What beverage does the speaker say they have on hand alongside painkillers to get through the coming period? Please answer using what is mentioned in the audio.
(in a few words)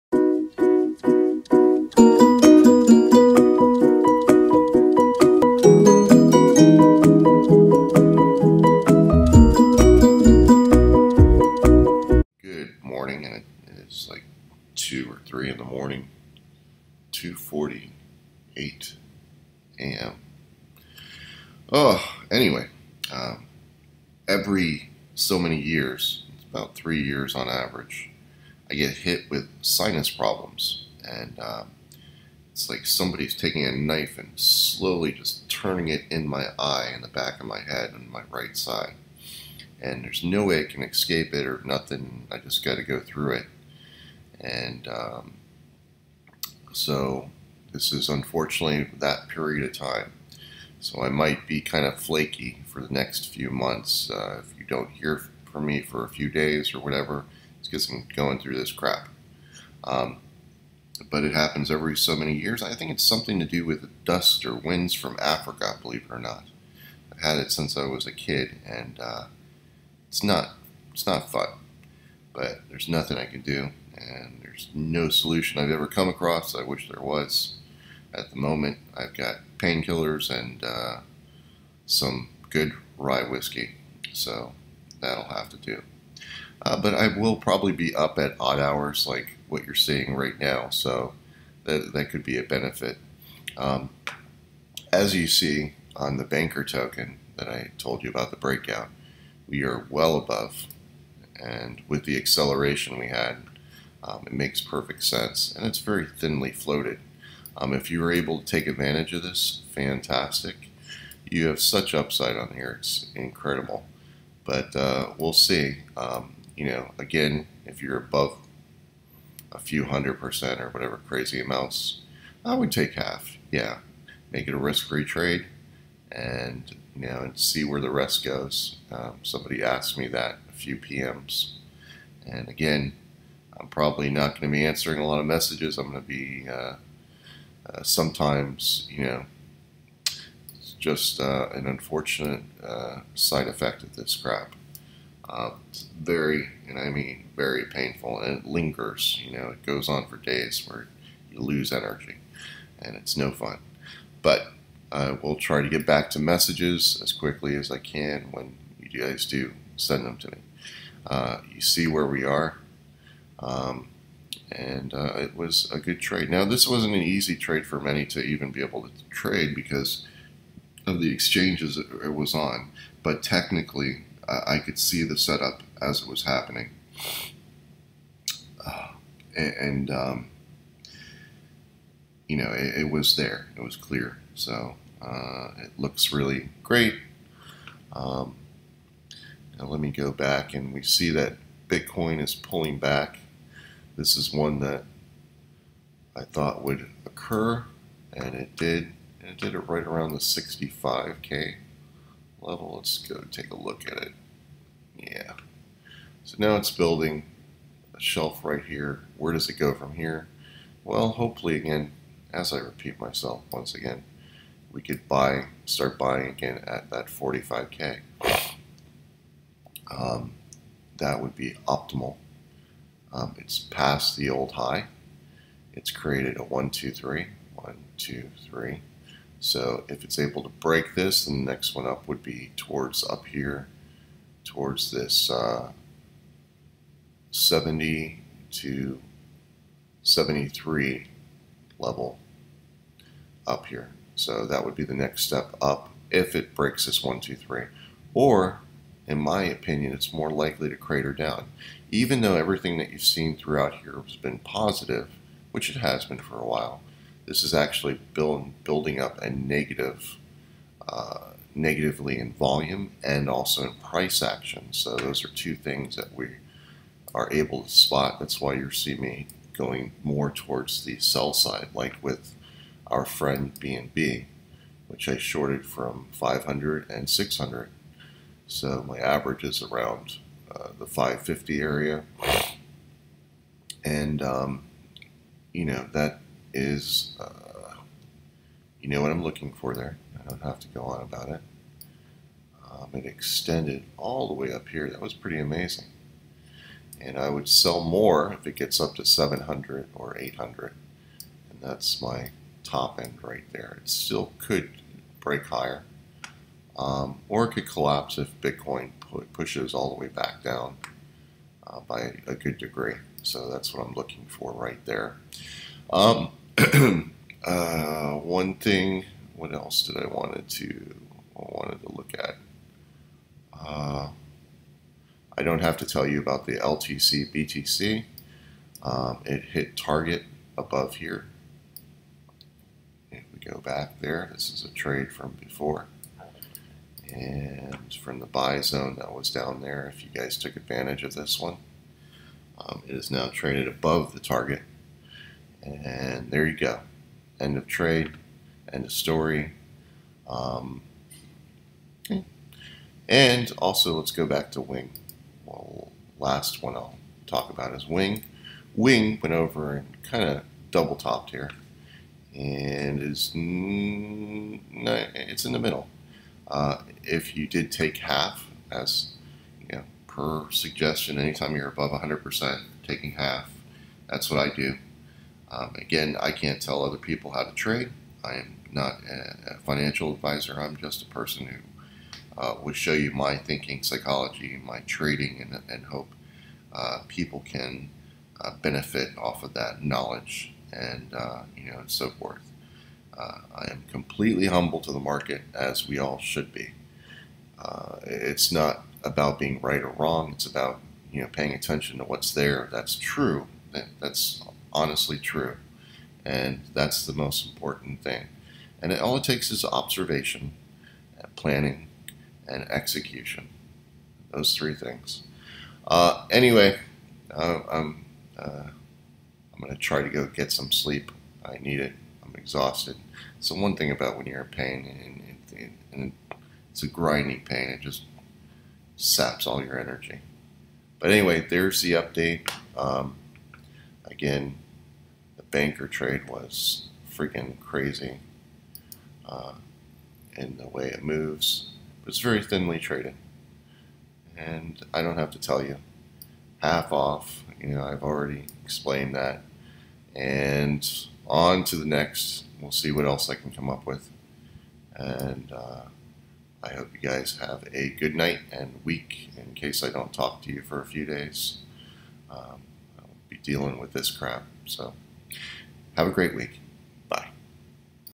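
rye whiskey.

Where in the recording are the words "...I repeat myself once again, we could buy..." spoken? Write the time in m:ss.
3:32.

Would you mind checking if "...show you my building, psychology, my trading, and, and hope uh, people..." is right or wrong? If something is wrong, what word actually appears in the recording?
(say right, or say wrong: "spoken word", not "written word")
wrong: "thinking", not "building".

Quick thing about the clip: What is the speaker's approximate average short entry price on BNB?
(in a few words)
550.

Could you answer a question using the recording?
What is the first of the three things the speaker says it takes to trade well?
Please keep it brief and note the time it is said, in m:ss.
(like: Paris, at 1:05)
observation, at 6:49.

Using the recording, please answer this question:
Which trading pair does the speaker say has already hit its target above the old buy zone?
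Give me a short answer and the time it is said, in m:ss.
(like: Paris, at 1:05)
LTC BTC, at 5:26.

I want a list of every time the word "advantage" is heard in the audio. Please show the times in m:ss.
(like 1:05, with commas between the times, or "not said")
1:48, 5:40.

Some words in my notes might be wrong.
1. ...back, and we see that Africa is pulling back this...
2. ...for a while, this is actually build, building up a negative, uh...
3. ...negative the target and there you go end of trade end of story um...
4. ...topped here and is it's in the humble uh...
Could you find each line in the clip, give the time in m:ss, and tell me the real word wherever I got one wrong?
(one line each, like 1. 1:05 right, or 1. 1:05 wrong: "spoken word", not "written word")
1. 3:10 wrong: "Bitcoin", not "Africa"
2. 4:16 right
3. 5:43 wrong: "above", not "negative"
4. 6:00 wrong: "middle", not "humble".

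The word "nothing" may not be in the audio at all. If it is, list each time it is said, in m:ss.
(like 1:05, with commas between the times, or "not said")
0:41, 1:12.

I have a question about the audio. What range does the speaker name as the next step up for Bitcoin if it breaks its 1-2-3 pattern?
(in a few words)
70 to 73.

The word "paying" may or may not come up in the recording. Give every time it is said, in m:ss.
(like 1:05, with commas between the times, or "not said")
6:41.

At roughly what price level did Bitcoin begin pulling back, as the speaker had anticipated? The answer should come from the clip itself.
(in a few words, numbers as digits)
65K.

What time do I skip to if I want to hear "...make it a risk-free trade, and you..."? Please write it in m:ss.
2:04.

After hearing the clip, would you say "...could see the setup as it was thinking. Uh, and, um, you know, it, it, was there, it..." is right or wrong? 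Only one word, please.
wrong.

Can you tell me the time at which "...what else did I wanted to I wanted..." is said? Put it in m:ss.
5:19.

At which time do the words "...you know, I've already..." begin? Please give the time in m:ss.
7:27.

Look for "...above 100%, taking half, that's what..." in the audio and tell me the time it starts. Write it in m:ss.
6:11.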